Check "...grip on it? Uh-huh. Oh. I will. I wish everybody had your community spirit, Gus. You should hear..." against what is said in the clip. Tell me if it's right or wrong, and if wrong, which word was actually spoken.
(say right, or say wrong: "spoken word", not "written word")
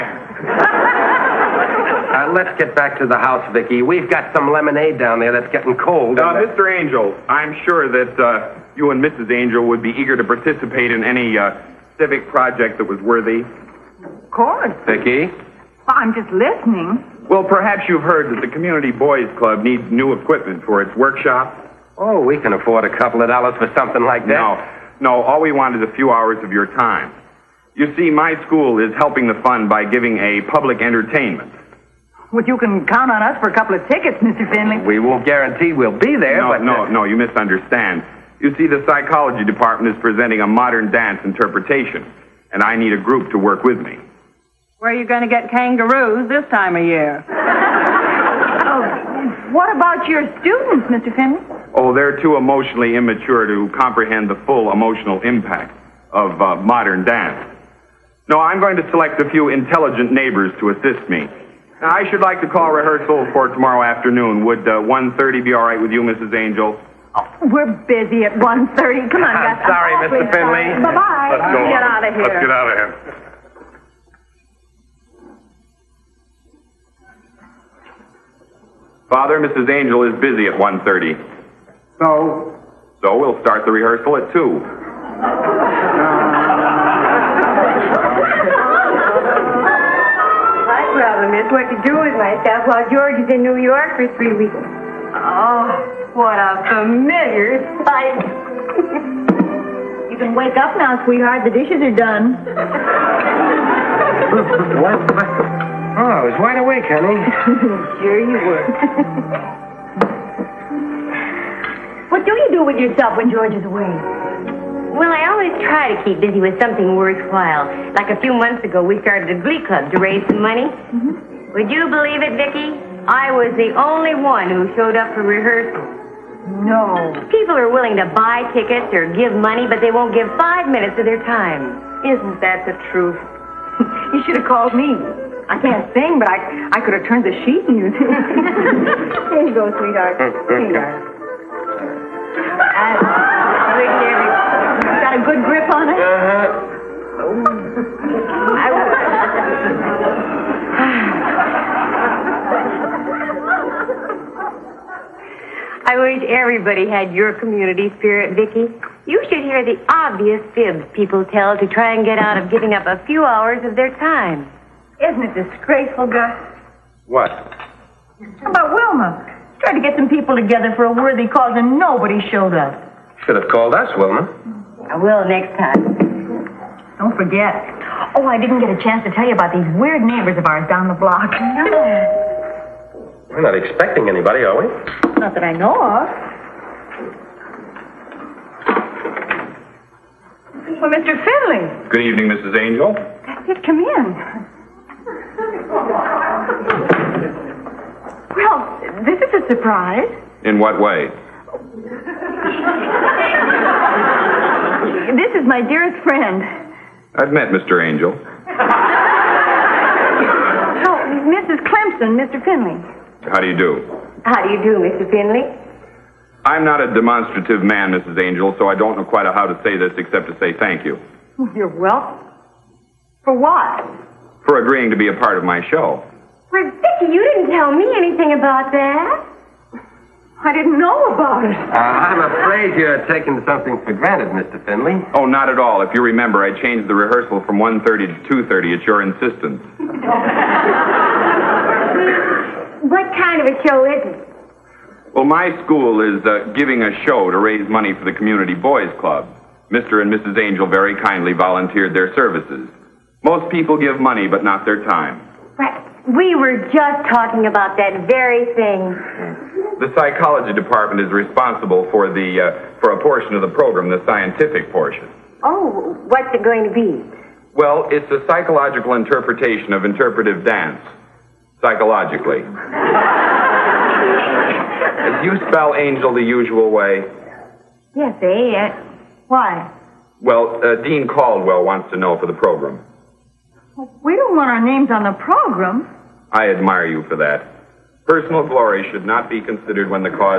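wrong: "Vicki", not "Gus".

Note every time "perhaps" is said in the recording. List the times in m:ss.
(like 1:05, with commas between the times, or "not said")
0:17.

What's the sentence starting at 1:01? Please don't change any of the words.
Now, I should like to call rehearsal for tomorrow afternoon.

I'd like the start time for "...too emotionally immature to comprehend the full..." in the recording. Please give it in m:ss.
0:52.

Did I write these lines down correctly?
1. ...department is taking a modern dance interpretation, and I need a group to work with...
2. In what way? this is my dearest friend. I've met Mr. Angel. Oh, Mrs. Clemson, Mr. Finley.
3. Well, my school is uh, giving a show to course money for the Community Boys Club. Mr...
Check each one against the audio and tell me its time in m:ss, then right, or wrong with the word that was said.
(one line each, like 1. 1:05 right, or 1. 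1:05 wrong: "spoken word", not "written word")
1. 0:39 wrong: "presenting", not "taking"
2. 3:20 right
3. 4:05 wrong: "raise", not "course".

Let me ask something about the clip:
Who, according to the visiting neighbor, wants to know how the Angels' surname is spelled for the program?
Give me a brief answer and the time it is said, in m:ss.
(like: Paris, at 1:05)
Dean Caldwell, at 4:40.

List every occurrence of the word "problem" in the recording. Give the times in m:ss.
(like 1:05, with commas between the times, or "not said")
1:30.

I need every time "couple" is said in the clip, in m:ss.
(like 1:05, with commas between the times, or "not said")
0:22, 0:33.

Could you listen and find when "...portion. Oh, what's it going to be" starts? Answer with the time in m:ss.
4:24.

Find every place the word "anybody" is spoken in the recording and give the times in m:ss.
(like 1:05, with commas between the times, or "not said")
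3:04.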